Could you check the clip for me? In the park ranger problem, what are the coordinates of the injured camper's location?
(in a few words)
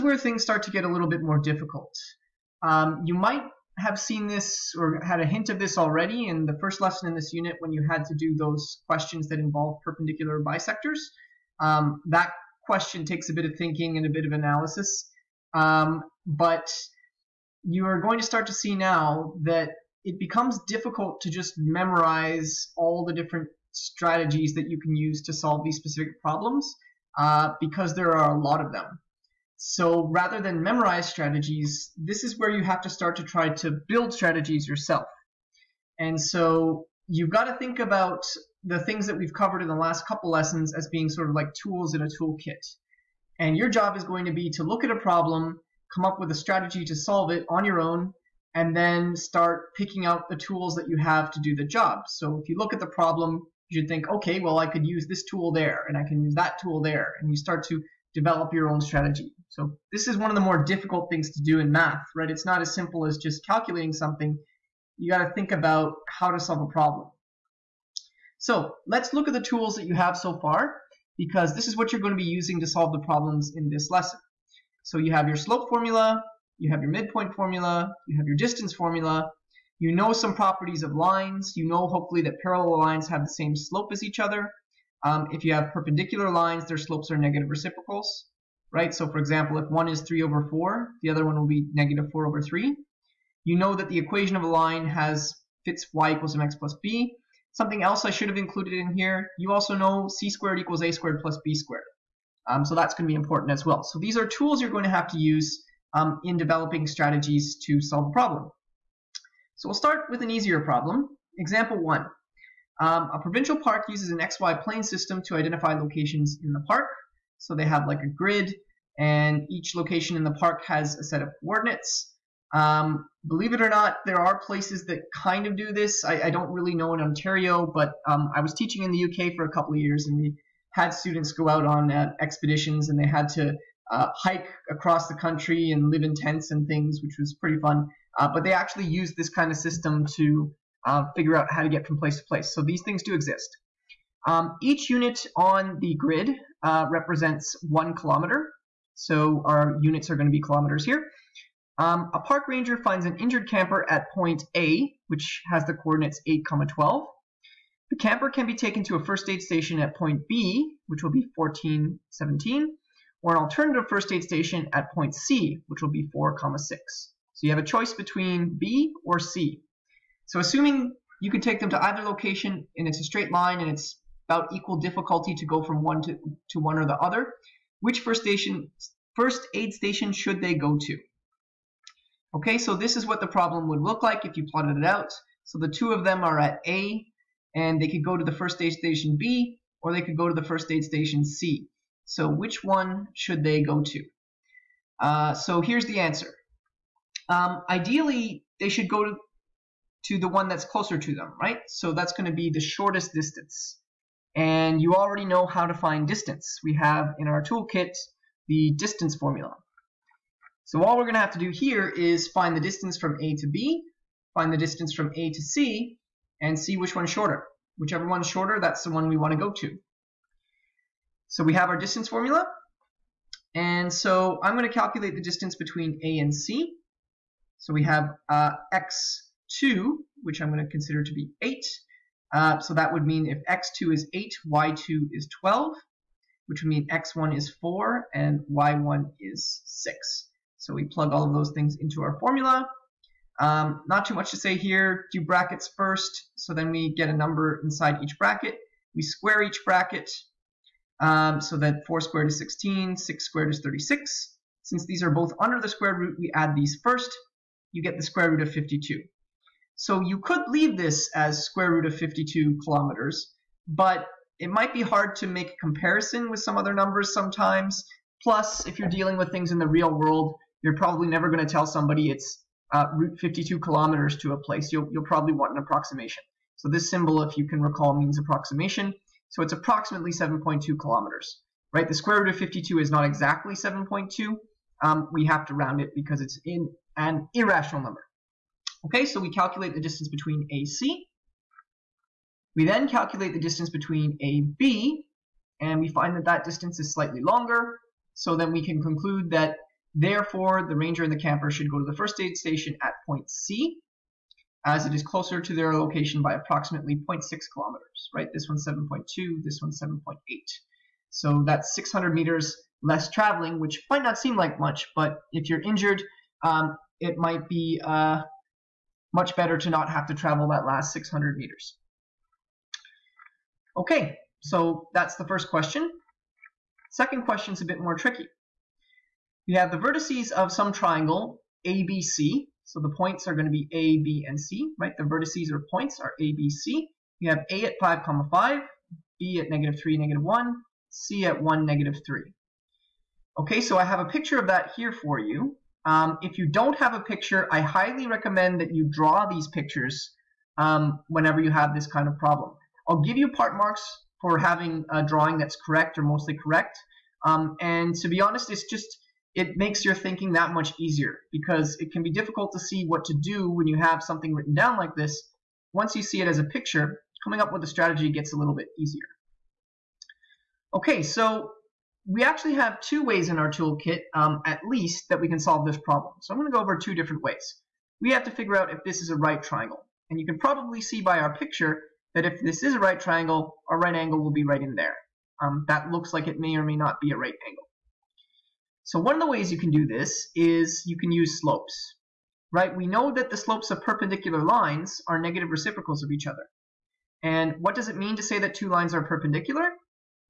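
8, 12.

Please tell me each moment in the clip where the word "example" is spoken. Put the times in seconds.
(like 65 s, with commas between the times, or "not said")
89 s, 111 s.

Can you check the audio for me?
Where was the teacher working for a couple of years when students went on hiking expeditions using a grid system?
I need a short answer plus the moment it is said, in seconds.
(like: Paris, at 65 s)
the UK, at 128 s.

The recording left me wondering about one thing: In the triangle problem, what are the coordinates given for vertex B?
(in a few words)
-3, -1.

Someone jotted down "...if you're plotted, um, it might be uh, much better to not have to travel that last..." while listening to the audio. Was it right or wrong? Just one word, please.
wrong.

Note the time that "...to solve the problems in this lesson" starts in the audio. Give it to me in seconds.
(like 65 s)
72 s.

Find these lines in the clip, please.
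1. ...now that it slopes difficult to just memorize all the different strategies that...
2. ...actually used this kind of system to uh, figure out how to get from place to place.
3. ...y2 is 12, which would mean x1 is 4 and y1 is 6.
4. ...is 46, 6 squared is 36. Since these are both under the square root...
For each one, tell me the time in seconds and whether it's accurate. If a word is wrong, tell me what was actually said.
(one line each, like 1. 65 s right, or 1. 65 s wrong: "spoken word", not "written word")
1. 18 s wrong: "becomes", not "slopes"
2. 138 s right
3. 234 s right
4. 252 s wrong: "16", not "46".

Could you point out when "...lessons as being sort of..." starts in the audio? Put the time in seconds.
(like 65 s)
40 s.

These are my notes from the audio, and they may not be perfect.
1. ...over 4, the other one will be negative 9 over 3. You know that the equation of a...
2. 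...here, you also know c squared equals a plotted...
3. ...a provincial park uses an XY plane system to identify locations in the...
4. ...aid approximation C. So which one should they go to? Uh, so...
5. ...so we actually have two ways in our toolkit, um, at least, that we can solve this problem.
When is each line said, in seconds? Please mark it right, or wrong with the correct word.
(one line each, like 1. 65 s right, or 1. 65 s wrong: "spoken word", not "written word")
1. 90 s wrong: "4", not "9"
2. 98 s wrong: "squared", not "plotted"
3. 113 s right
4. 190 s wrong: "station", not "approximation"
5. 371 s right.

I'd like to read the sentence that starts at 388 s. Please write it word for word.
So one of the ways you can do this is you can use slopes, right?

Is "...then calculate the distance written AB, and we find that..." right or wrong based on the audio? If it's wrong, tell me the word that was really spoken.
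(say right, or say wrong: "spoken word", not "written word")
wrong: "between", not "written".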